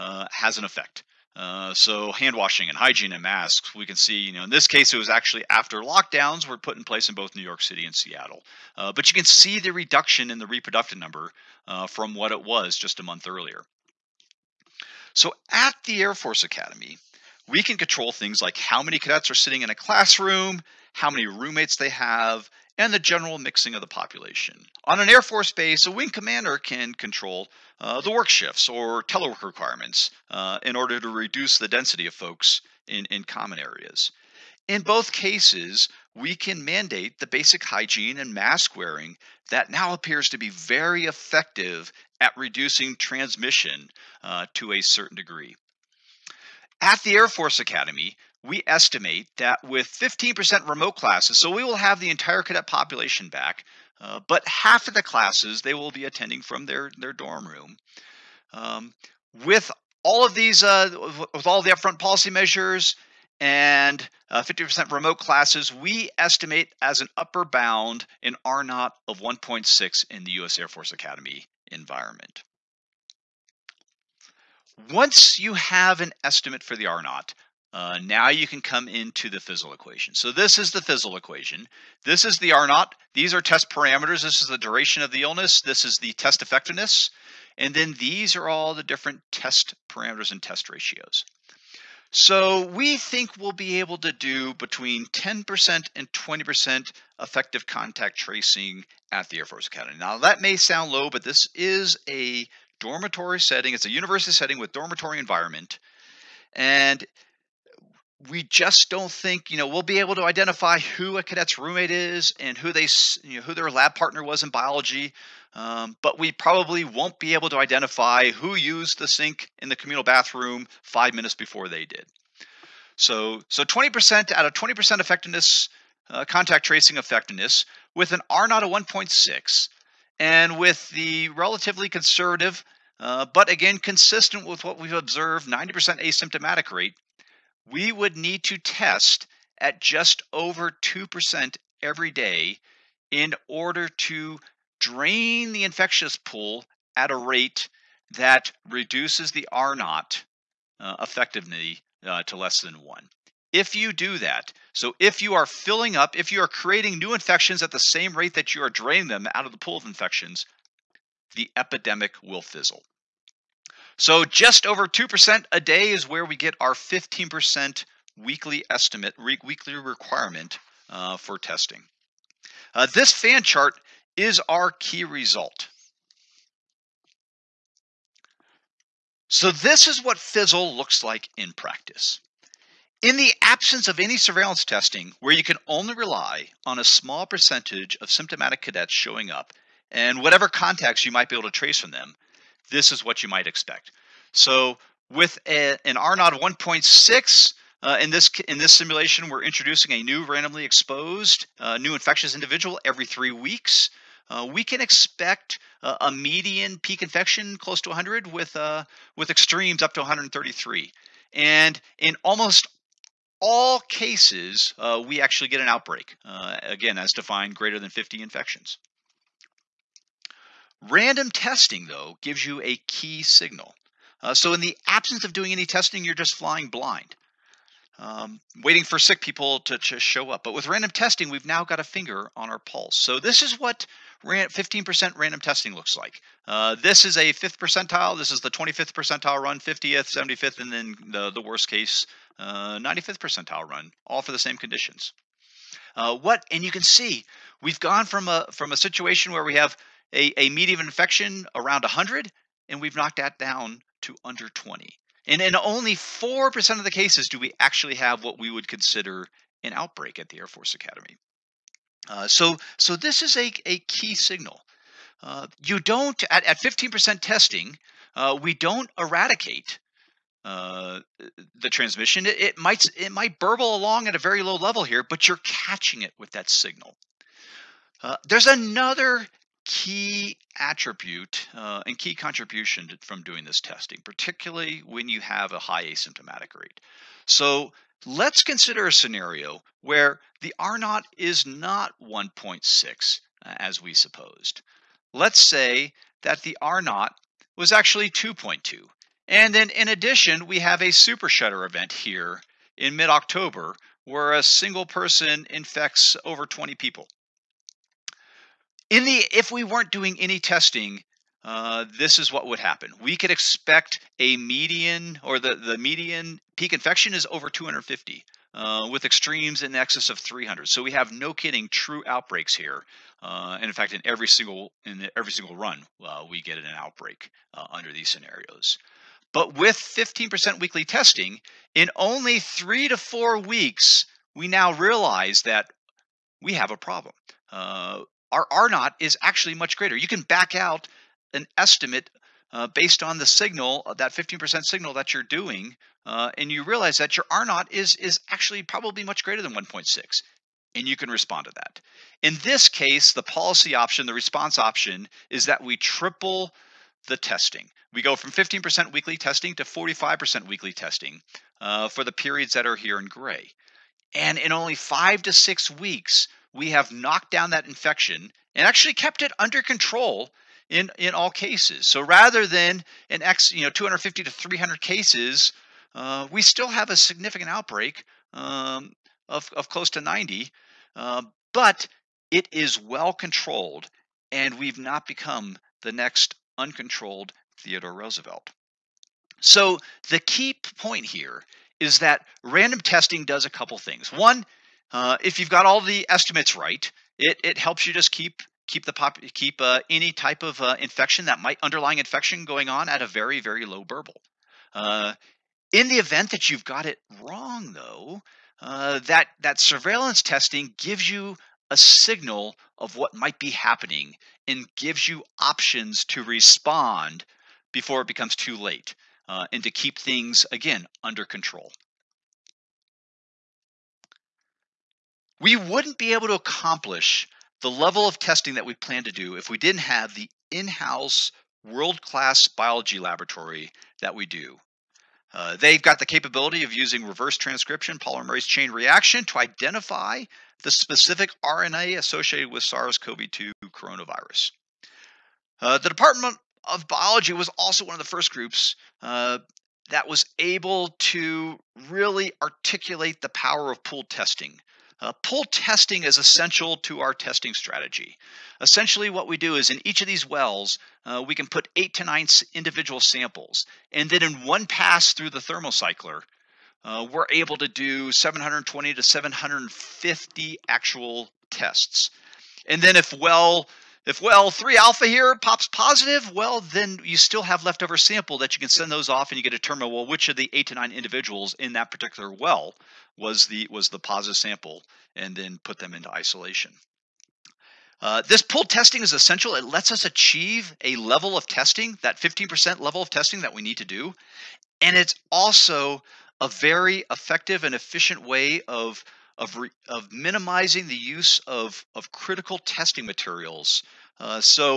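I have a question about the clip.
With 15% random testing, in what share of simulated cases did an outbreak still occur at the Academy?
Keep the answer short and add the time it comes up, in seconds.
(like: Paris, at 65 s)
4%, at 255 s.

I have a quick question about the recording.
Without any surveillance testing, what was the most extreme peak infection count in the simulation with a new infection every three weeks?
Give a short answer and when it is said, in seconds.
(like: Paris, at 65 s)
133, at 209 s.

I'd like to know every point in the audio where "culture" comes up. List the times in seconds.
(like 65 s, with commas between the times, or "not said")
not said.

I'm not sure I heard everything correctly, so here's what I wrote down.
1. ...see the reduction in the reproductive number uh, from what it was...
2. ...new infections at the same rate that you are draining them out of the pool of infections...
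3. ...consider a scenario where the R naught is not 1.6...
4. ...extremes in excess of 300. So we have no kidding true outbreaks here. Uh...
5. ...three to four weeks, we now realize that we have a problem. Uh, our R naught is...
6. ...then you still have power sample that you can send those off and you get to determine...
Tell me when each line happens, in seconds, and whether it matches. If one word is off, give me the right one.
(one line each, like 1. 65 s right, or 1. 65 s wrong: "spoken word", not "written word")
1. 9 s right
2. 156 s right
3. 288 s right
4. 319 s right
5. 332 s right
6. 476 s wrong: "leftover", not "power".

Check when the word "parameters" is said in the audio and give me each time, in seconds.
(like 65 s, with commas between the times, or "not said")
83 s, 89 s.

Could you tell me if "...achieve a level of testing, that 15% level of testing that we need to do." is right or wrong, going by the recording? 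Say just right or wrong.
right.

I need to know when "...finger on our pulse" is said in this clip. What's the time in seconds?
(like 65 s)
231 s.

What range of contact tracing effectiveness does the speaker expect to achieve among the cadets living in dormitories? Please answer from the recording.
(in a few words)
10% to 20%.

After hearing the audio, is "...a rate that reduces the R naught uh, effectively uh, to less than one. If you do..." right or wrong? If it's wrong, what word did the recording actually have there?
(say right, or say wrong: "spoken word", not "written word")
right.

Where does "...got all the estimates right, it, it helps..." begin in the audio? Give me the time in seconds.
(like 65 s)
395 s.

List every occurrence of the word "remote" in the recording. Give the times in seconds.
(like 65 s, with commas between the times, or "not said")
50 s, 64 s.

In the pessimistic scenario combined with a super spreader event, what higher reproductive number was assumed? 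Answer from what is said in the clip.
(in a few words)
2.2.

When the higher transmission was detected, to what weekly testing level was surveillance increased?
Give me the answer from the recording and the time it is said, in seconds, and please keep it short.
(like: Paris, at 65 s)
45%, at 359 s.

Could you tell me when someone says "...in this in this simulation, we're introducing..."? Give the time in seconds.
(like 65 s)
198 s.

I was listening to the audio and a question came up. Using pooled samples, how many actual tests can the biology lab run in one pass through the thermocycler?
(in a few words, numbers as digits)
720 to 750.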